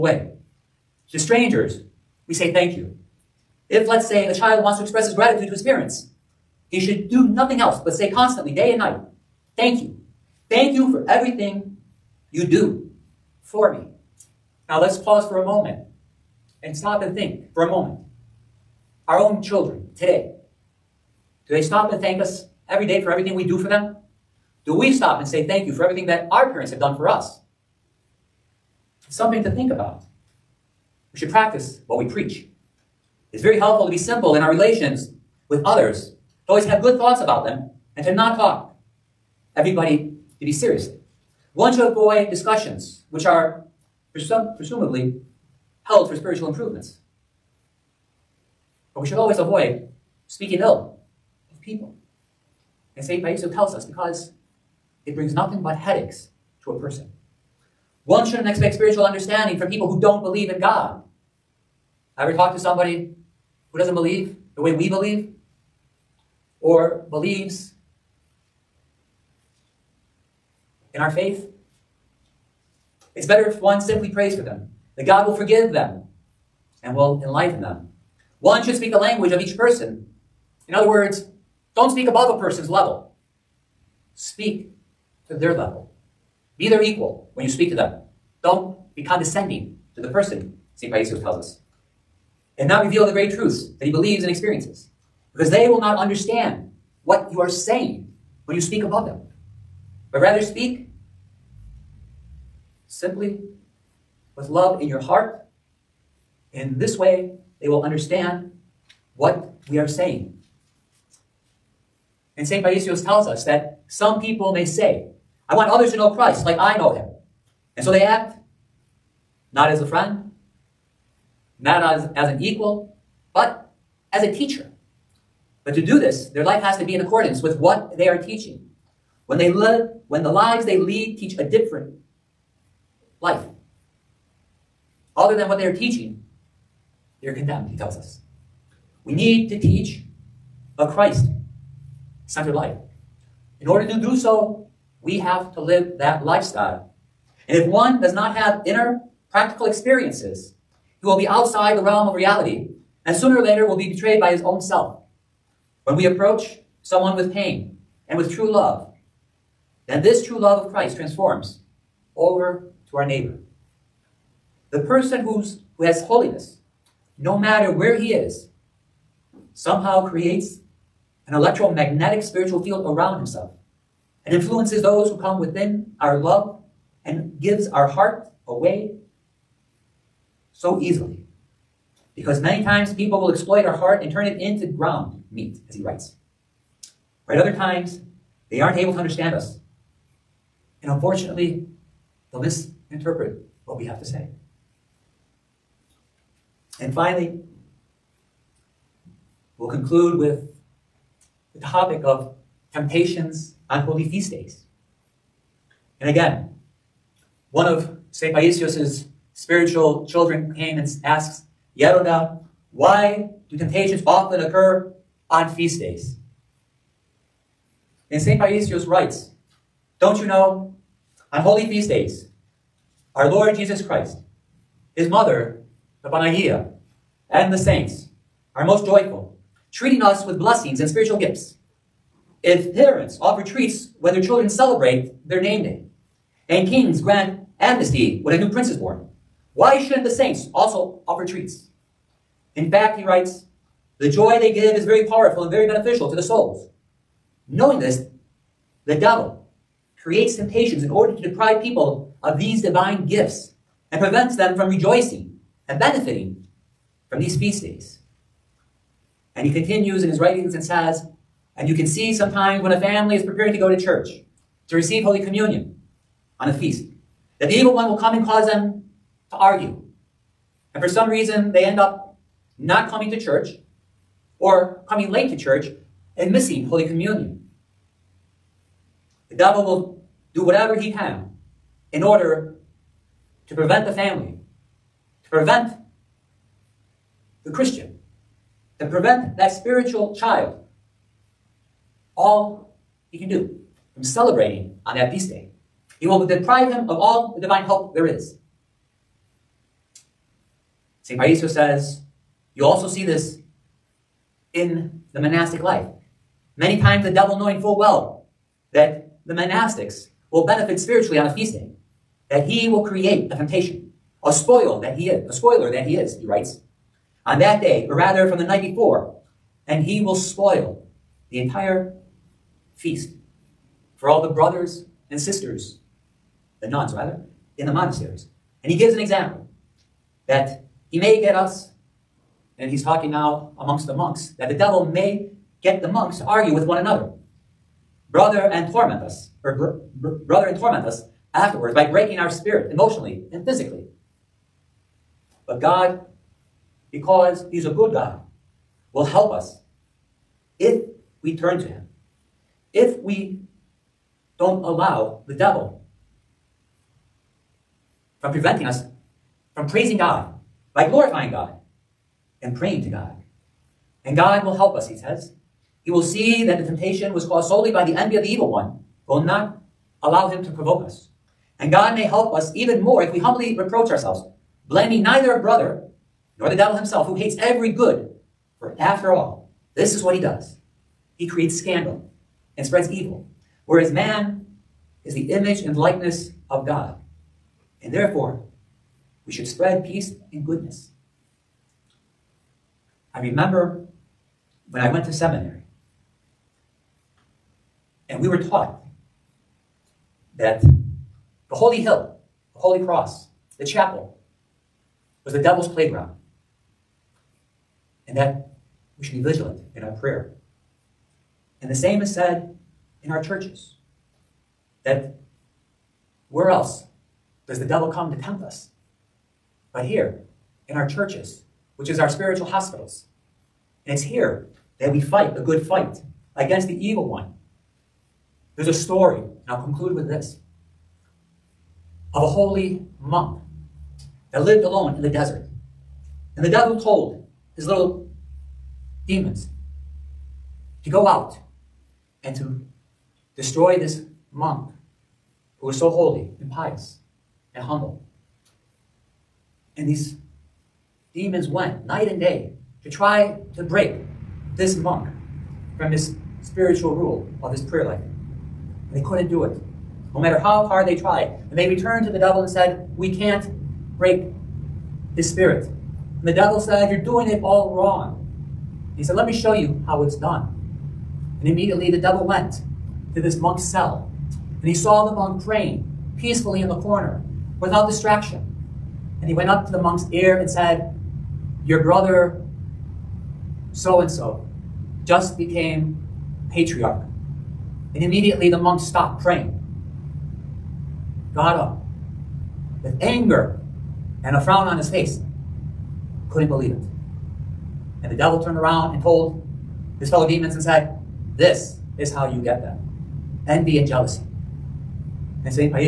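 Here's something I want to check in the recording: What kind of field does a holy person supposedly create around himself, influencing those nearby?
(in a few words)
electromagnetic spiritual field.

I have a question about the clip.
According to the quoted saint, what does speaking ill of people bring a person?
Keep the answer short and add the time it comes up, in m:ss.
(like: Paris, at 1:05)
headaches, at 0:55.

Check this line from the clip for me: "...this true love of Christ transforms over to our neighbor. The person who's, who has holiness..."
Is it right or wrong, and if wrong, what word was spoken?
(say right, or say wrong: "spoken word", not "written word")
right.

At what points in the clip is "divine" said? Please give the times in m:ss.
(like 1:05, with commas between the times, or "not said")
4:12, 4:57.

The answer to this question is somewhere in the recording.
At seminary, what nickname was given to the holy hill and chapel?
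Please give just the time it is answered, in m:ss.
6:45.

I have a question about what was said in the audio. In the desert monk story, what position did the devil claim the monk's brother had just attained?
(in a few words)
patriarch.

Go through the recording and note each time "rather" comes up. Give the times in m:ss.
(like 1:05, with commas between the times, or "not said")
1:40, 5:17, 5:26.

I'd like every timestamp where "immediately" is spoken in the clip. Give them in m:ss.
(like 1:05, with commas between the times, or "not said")
7:51, 8:08.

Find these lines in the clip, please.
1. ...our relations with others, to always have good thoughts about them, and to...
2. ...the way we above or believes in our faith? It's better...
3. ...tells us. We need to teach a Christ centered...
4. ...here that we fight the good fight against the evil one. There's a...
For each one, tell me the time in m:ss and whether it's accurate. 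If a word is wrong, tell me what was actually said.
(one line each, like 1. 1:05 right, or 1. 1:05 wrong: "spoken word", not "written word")
1. 0:34 right
2. 1:04 wrong: "believe", not "above"
3. 2:17 right
4. 7:04 right.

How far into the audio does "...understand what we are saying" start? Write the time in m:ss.
1:47.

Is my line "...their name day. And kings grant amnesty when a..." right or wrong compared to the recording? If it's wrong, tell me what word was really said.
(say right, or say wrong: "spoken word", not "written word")
right.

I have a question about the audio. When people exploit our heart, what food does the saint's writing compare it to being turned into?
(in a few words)
ground meat.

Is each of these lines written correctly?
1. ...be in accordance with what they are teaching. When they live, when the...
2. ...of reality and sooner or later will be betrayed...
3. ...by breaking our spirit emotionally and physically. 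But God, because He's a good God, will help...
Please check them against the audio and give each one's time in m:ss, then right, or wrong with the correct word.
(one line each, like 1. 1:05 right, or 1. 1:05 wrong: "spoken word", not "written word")
1. 2:06 right
2. 2:32 right
3. 5:41 right.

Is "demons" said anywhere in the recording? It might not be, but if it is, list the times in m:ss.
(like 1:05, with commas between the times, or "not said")
7:19, 7:31, 8:20.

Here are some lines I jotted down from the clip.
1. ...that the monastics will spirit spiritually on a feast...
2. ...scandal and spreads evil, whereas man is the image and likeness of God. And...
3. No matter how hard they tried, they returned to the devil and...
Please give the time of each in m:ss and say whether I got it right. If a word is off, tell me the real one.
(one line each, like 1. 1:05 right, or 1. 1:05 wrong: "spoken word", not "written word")
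1. 5:08 wrong: "benefit", not "spirit"
2. 6:21 right
3. 7:40 right.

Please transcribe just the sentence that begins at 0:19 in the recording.
Our own children today, do they stop and thank us every day for everything we do for them?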